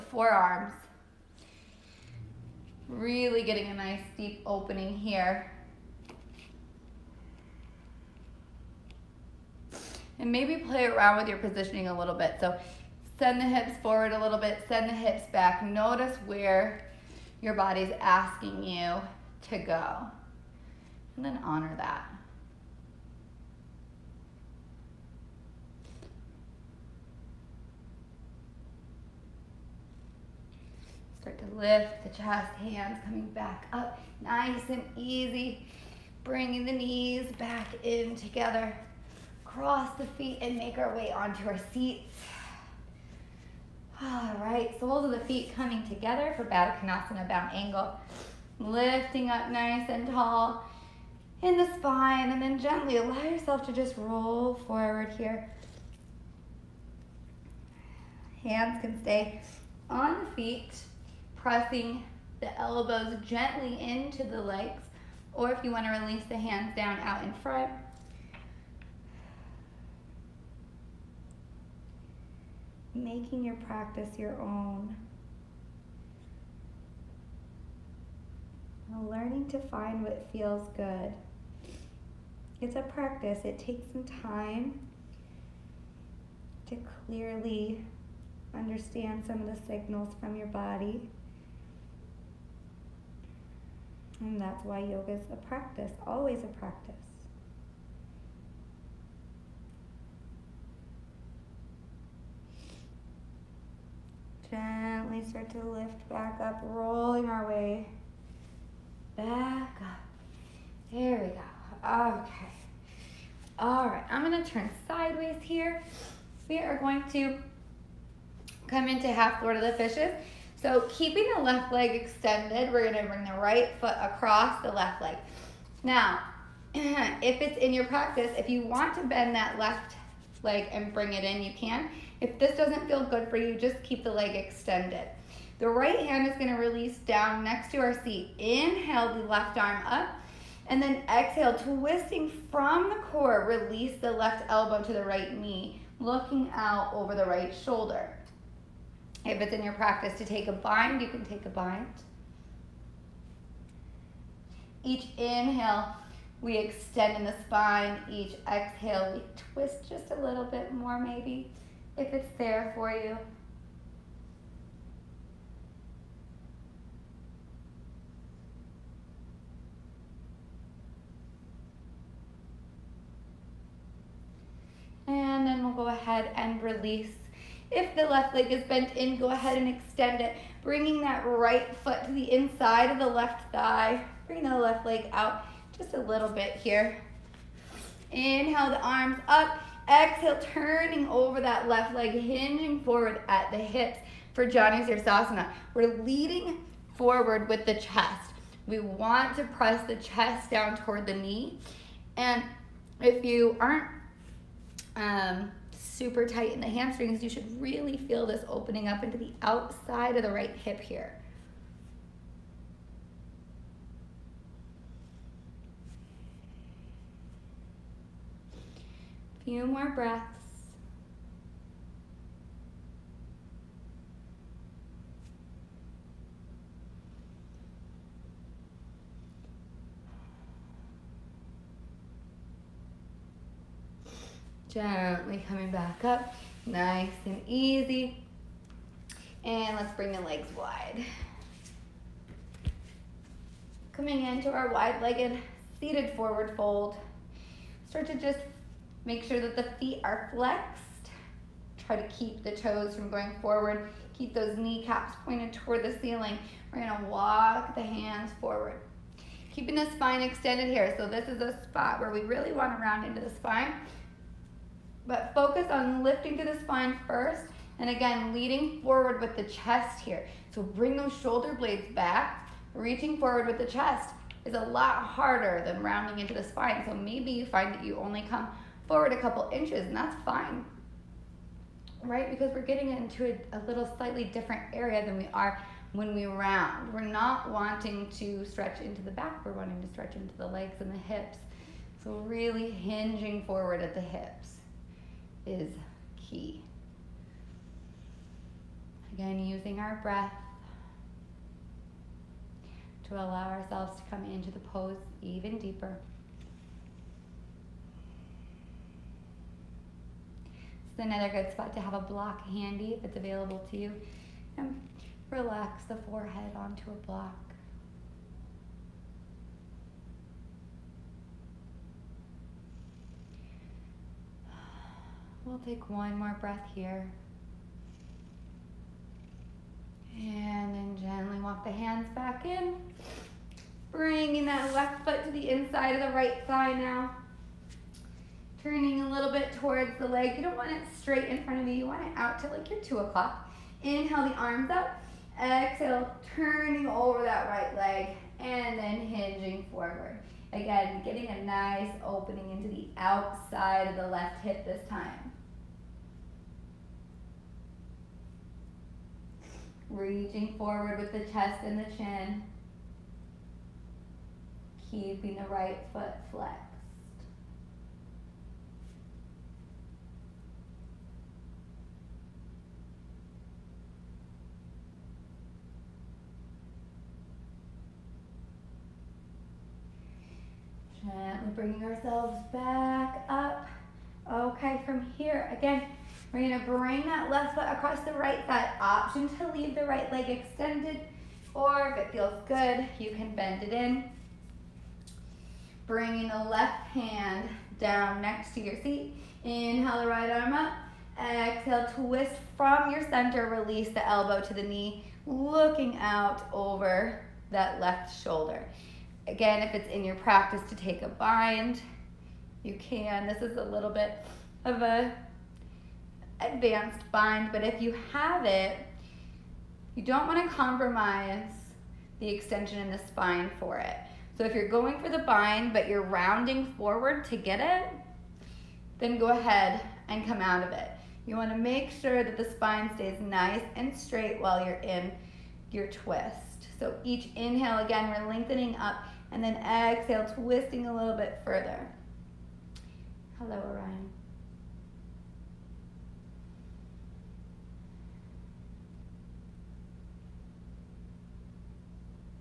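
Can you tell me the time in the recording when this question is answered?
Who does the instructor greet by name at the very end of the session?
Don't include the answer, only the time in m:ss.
7:23.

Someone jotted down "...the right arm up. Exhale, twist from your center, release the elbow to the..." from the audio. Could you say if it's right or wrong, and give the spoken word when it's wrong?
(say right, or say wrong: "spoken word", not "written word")
right.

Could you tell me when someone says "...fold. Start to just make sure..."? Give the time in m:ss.
4:06.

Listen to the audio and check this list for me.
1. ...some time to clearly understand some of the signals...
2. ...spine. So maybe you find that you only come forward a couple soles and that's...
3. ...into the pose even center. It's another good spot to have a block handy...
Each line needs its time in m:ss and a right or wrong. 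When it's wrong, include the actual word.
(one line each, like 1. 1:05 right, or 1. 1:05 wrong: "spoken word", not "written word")
1. 1:23 right
2. 4:36 wrong: "inches", not "soles"
3. 5:04 wrong: "deeper", not "center".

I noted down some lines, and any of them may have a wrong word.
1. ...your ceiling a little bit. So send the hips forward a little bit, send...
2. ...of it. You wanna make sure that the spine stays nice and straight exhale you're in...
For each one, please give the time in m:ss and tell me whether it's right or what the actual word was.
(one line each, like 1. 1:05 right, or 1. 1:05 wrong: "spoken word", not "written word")
1. 0:11 wrong: "positioning", not "ceiling"
2. 7:10 wrong: "while", not "exhale".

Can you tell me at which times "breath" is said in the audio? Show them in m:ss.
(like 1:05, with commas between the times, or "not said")
3:39, 5:00, 5:26.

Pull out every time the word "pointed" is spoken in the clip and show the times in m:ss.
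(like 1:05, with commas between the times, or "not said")
4:15.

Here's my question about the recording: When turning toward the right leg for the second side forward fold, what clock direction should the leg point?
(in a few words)
two o'clock.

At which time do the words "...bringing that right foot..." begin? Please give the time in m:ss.
3:00.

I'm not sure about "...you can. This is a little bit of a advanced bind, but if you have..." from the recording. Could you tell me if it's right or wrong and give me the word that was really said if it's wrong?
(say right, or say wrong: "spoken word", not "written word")
right.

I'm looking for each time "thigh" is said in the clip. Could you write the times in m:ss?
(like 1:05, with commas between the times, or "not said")
3:03, 5:36, 6:28.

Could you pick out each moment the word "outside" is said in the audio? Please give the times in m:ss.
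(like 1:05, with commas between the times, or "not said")
3:29, 5:53.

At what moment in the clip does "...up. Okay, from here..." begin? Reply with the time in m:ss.
6:23.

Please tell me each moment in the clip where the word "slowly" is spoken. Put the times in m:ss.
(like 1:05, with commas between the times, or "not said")
not said.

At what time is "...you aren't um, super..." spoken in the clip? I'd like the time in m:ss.
3:23.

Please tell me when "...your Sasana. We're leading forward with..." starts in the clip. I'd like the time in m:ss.
3:14.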